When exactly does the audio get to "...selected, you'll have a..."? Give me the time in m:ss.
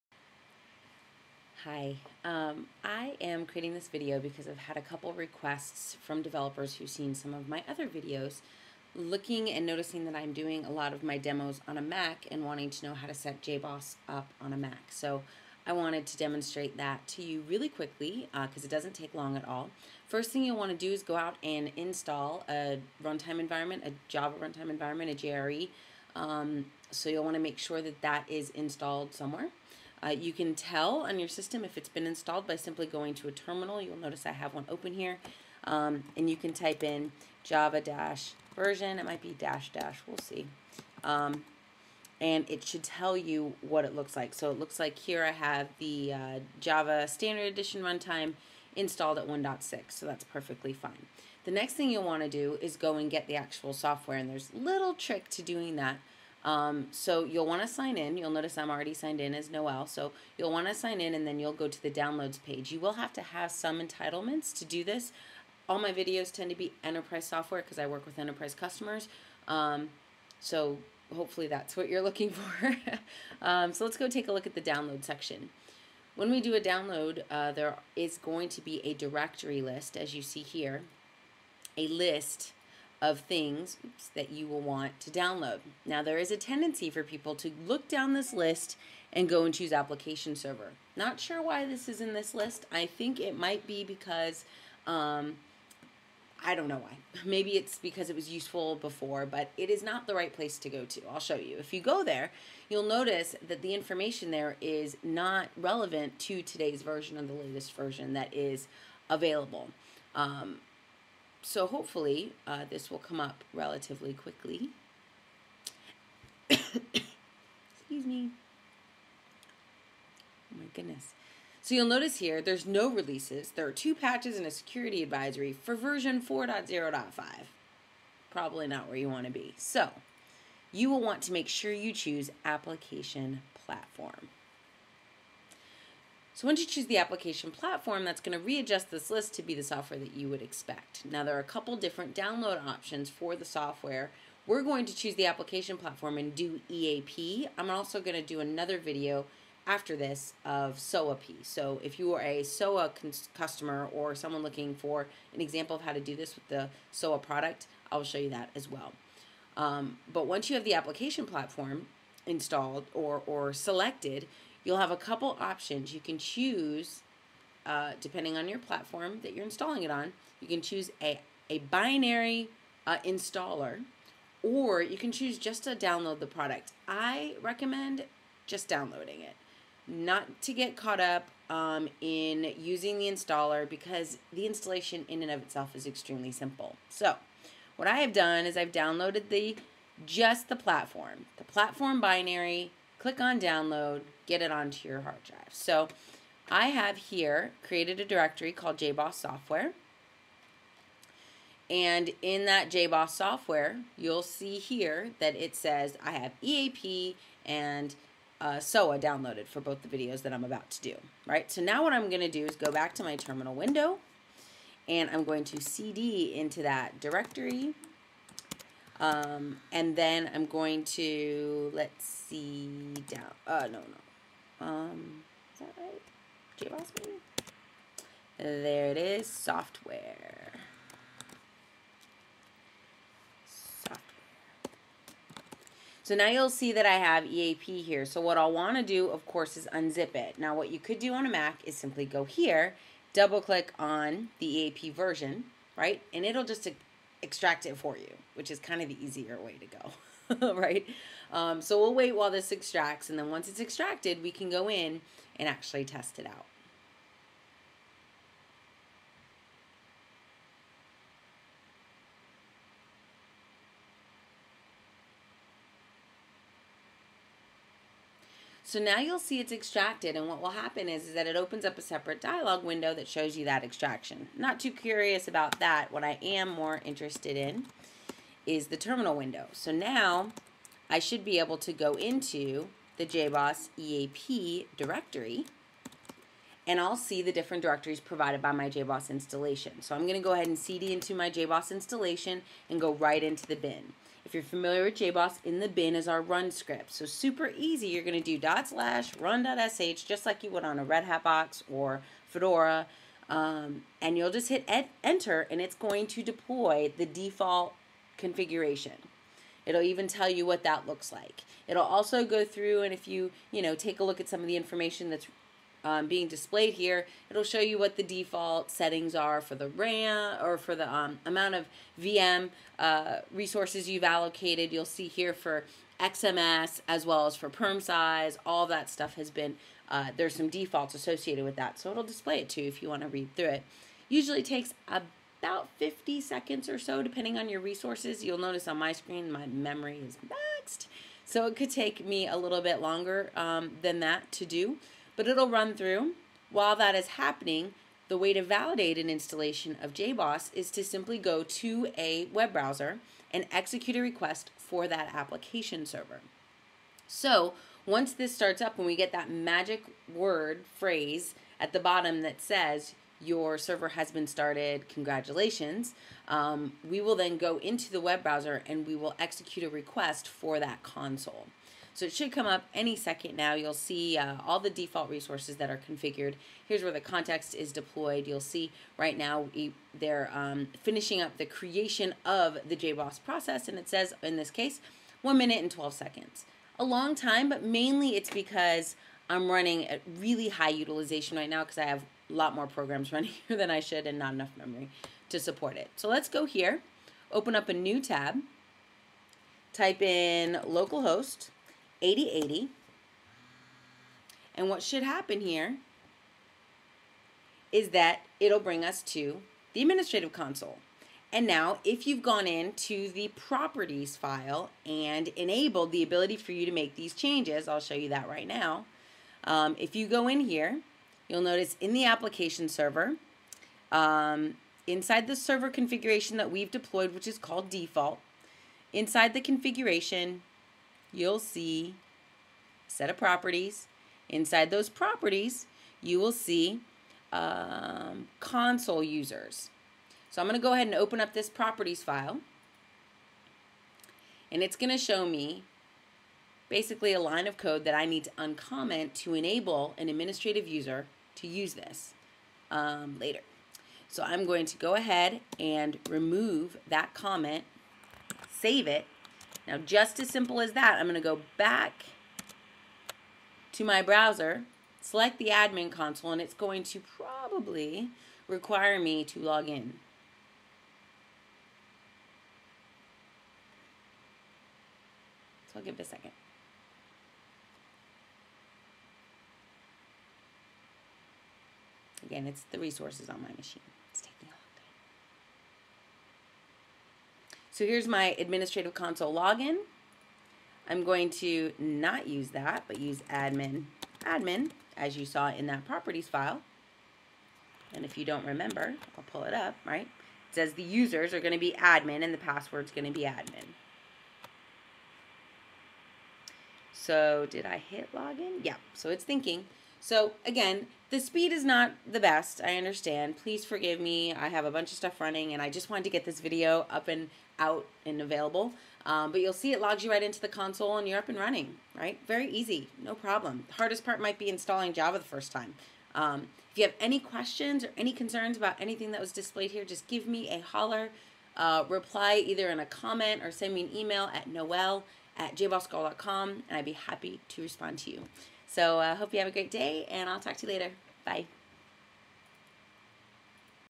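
2:43.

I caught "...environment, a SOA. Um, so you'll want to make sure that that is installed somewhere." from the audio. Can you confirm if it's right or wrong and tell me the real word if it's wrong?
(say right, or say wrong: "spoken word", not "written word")
wrong: "JRE", not "SOA".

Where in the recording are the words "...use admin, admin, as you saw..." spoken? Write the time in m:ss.
8:12.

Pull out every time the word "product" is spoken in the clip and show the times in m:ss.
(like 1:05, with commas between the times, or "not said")
2:37, 2:56.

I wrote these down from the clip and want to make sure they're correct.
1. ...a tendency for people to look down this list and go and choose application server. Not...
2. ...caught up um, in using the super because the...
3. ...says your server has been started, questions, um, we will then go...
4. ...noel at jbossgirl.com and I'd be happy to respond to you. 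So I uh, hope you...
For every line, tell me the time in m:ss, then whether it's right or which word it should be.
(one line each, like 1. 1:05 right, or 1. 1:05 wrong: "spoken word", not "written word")
1. 1:26 right
2. 3:00 wrong: "installer", not "super"
3. 6:02 wrong: "congratulations", not "questions"
4. 8:54 right.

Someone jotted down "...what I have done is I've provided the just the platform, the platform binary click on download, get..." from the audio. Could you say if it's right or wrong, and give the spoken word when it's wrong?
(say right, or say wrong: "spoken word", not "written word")
wrong: "downloaded", not "provided".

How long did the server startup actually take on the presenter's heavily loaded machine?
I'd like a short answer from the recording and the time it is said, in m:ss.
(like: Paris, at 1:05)
1 minute 12 seconds, at 6:25.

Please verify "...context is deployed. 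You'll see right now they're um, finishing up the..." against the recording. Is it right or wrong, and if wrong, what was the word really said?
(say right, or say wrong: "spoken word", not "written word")
right.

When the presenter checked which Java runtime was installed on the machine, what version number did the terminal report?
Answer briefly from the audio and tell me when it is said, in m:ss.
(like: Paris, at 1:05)
1.6, at 0:49.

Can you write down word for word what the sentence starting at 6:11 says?
So it should come up any second now.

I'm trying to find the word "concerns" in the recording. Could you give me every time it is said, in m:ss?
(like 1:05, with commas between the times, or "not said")
8:48.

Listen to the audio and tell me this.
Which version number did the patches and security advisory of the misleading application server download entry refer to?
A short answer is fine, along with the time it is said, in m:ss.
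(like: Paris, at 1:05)
4.0.5, at 2:06.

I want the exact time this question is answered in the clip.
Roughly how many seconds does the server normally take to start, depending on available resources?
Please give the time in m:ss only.
5:35.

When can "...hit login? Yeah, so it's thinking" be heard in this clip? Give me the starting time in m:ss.
8:27.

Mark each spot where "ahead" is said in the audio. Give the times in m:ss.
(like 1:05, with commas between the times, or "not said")
4:50, 7:20, 7:34.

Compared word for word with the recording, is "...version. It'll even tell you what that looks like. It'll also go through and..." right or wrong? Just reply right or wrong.
wrong.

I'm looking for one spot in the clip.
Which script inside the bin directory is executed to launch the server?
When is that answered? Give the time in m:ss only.
4:59.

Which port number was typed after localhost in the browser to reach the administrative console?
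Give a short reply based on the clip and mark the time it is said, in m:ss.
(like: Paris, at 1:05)
8080, at 6:42.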